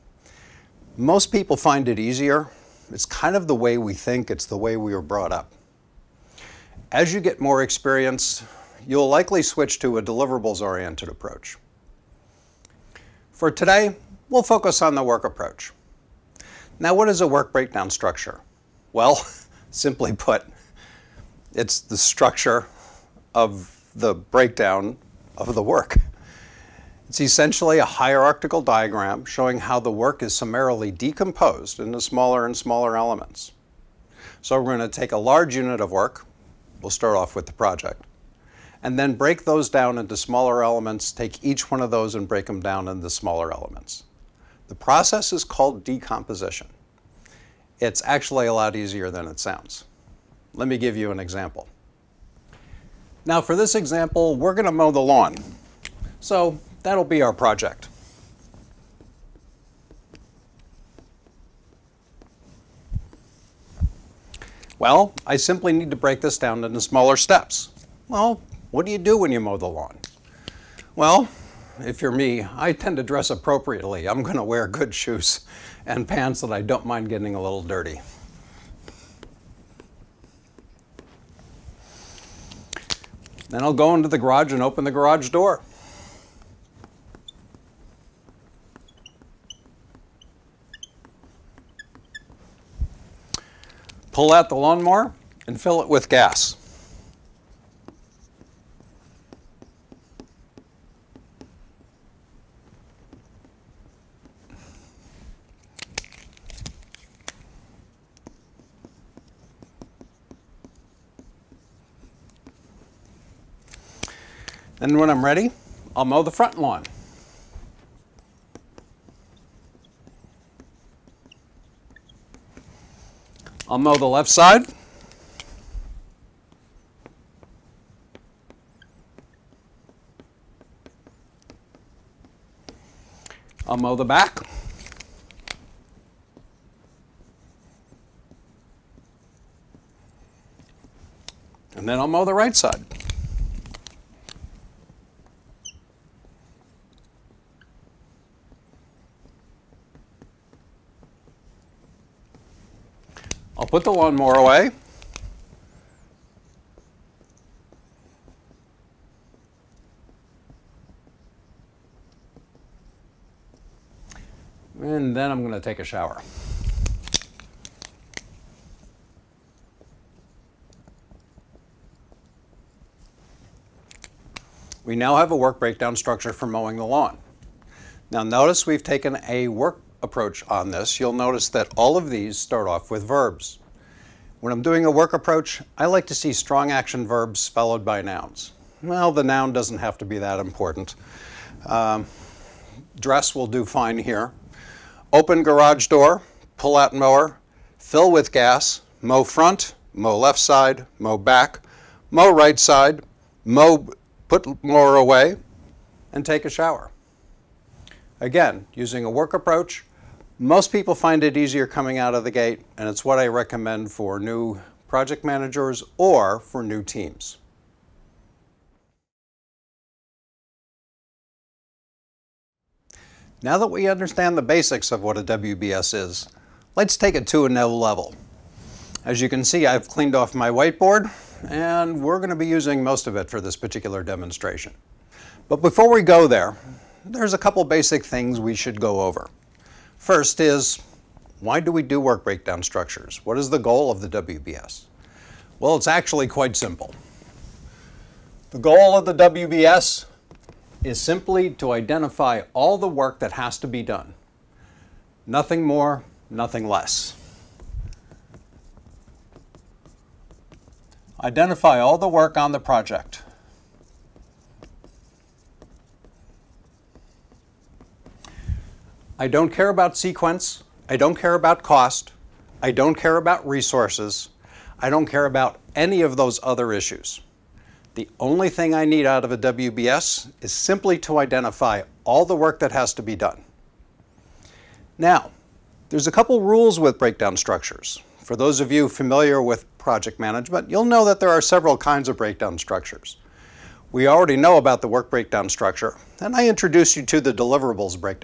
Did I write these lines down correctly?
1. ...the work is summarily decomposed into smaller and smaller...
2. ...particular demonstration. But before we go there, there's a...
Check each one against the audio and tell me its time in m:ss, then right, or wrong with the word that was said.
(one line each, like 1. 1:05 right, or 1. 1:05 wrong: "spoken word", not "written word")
1. 0:29 right
2. 3:53 right.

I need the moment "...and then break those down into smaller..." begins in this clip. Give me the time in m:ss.
0:38.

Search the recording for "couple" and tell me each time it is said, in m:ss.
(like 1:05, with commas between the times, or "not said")
3:57, 4:46.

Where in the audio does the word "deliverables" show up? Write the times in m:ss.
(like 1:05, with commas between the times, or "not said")
0:10, 4:57.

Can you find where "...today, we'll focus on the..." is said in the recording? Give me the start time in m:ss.
0:13.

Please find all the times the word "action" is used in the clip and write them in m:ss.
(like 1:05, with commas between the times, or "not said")
3:06.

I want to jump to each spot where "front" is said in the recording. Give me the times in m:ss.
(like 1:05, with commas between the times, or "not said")
1:56, 3:19.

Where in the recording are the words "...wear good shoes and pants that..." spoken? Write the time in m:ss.
1:14.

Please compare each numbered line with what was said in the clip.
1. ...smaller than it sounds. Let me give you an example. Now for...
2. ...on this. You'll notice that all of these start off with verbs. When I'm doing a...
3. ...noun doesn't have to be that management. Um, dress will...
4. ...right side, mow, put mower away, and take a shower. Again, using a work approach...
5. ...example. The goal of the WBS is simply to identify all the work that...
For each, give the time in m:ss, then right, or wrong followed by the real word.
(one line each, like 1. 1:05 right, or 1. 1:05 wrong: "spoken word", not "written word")
1. 0:48 wrong: "easier", not "smaller"
2. 3:00 right
3. 3:09 wrong: "important", not "management"
4. 3:22 right
5. 4:06 wrong: "simple", not "example".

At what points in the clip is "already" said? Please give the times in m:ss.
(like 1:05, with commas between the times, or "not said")
4:54.